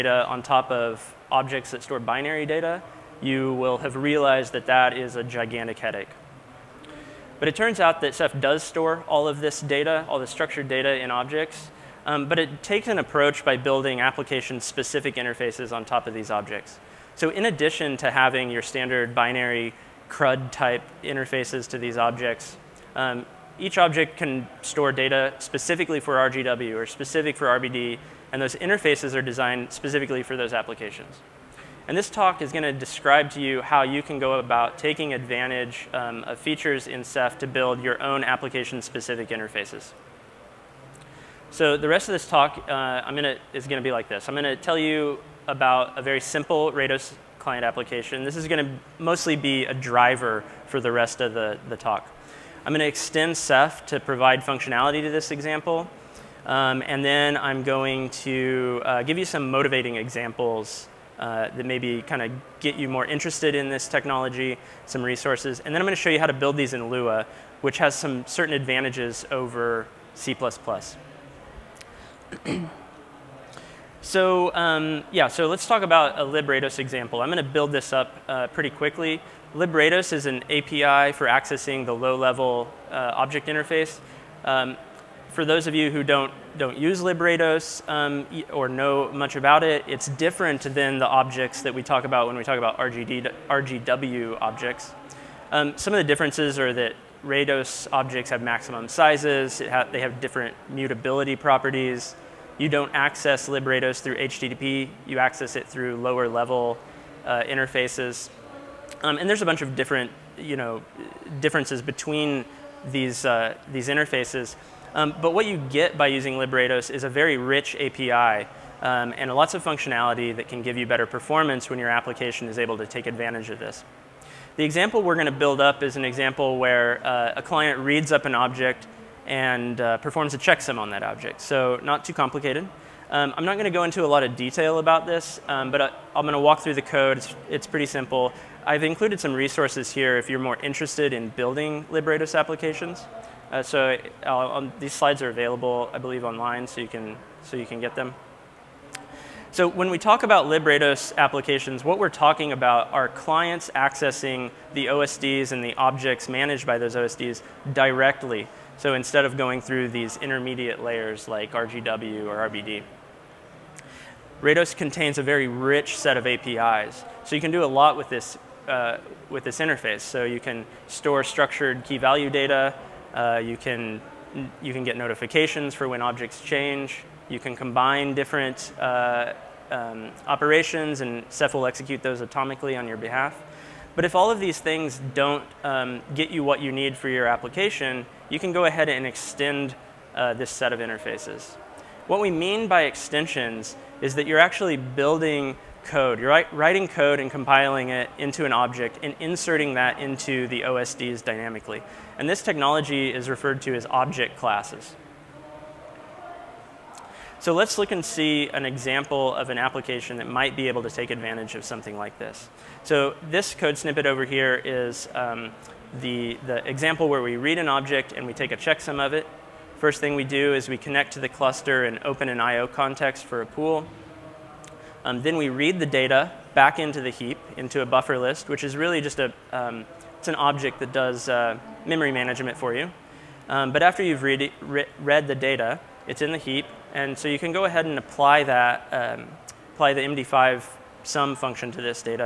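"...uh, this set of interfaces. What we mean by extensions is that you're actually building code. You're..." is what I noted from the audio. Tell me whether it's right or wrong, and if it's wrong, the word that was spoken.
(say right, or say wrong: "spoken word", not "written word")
right.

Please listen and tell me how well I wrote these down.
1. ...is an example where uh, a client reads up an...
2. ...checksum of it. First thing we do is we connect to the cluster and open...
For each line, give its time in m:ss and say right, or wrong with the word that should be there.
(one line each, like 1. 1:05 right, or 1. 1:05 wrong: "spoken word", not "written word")
1. 2:05 right
2. 3:38 right.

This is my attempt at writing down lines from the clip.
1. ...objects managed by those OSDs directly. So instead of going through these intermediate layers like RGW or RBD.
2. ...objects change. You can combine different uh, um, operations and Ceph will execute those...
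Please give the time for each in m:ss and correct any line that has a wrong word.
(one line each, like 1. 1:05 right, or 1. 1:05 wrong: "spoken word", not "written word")
1. 2:35 right
2. 2:56 right.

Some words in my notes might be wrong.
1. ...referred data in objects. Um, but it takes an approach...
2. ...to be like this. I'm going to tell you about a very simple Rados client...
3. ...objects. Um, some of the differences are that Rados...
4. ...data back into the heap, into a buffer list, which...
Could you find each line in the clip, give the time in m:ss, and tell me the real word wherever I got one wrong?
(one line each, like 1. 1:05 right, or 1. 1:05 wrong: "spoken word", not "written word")
1. 0:10 wrong: "structured", not "referred"
2. 0:43 right
3. 1:34 right
4. 3:45 right.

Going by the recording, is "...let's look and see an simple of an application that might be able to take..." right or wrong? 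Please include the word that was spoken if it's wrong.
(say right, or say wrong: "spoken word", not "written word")
wrong: "example", not "simple".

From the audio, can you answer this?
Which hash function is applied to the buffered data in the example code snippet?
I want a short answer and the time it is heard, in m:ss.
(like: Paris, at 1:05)
MD5, at 3:59.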